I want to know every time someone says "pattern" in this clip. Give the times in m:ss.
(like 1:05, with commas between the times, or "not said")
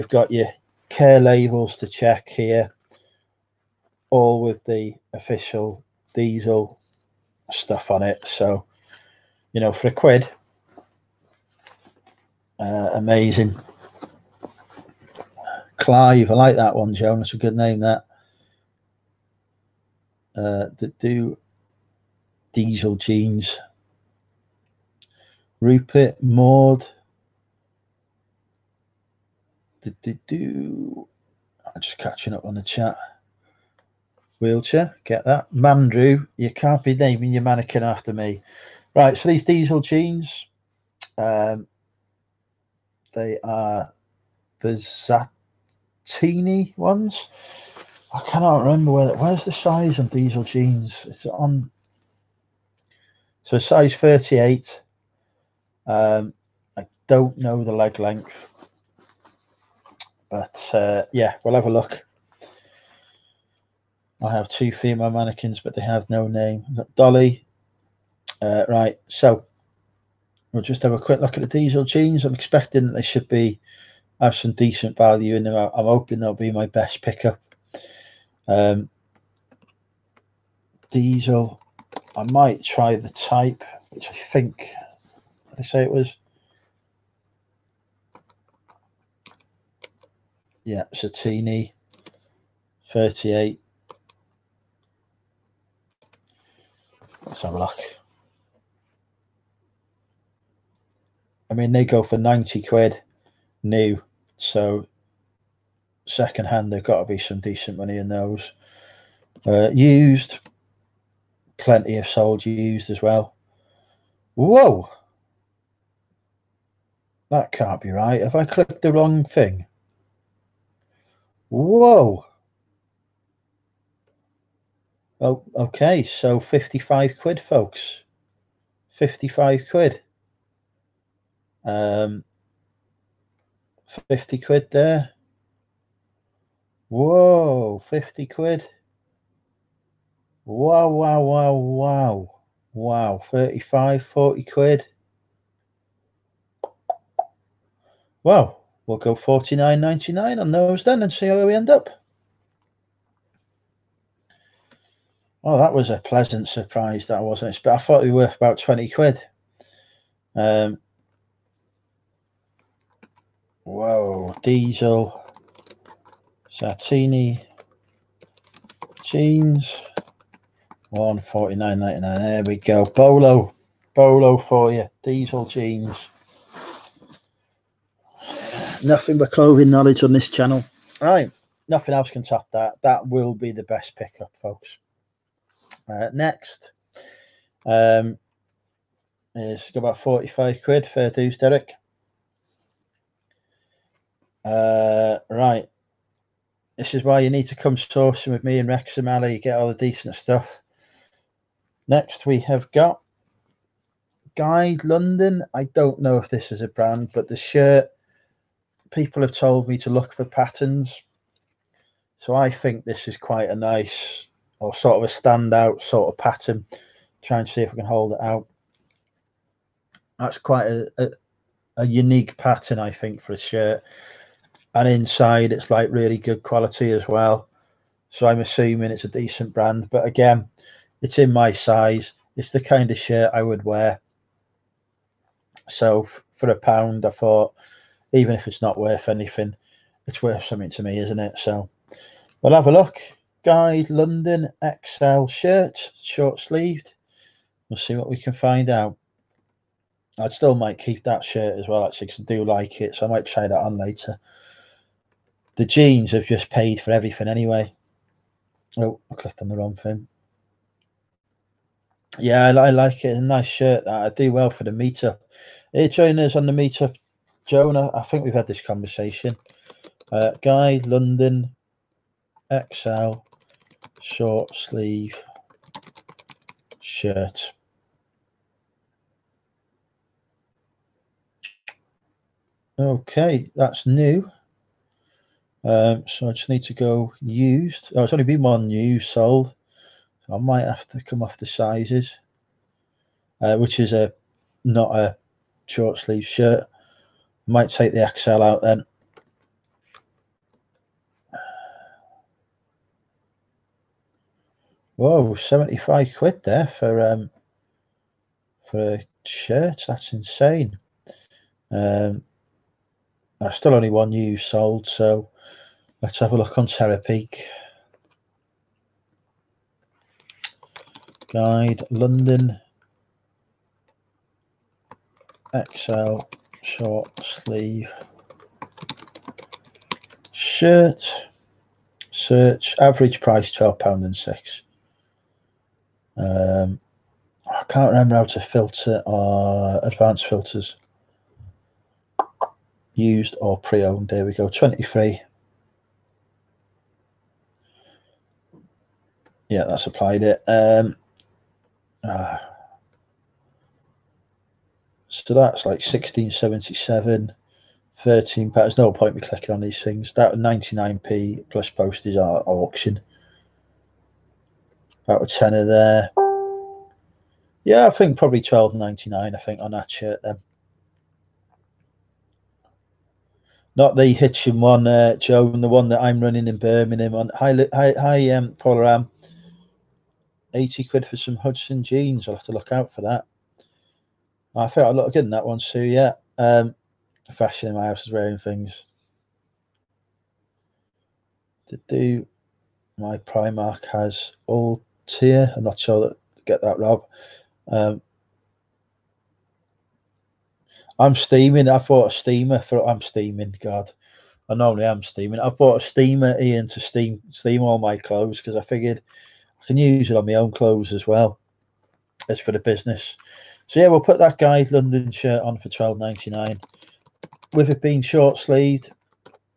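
3:30, 3:36, 3:42.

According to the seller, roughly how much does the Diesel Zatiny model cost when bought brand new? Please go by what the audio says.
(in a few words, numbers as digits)
£90.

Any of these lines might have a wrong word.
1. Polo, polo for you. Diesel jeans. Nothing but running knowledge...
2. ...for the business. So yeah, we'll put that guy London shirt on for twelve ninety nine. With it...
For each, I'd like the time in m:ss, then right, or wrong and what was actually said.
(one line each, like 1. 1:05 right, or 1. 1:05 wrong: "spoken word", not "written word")
1. 2:52 wrong: "clothing", not "running"
2. 6:52 right.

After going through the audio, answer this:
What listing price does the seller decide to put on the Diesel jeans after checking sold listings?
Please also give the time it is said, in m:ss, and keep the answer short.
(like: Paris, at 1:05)
£49.99, at 2:29.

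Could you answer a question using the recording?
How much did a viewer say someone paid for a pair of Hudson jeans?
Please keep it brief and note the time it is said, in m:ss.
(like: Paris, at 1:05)
£80, at 6:20.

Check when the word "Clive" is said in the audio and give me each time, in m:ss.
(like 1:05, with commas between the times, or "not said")
0:15.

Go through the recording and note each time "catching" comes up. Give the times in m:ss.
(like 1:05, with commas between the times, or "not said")
0:31.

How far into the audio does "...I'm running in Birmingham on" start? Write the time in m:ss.
6:16.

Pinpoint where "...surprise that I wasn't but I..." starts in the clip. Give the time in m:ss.
2:36.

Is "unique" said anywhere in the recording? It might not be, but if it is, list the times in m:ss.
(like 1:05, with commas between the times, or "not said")
3:41.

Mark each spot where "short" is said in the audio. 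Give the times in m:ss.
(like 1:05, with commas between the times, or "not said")
4:06, 4:34, 4:55, 5:26, 6:58.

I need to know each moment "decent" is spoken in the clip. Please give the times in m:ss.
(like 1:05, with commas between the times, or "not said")
1:14, 1:47, 3:19, 3:49.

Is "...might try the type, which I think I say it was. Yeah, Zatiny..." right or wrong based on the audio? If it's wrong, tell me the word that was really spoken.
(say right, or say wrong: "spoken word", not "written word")
right.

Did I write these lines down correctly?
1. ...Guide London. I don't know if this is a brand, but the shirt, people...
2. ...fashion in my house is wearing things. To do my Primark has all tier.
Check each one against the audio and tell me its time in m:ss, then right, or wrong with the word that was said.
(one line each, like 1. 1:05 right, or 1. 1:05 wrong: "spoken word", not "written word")
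1. 3:24 right
2. 6:27 right.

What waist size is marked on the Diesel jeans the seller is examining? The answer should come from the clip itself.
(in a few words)
38.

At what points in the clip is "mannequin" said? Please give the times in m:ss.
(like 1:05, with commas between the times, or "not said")
0:37, 1:05.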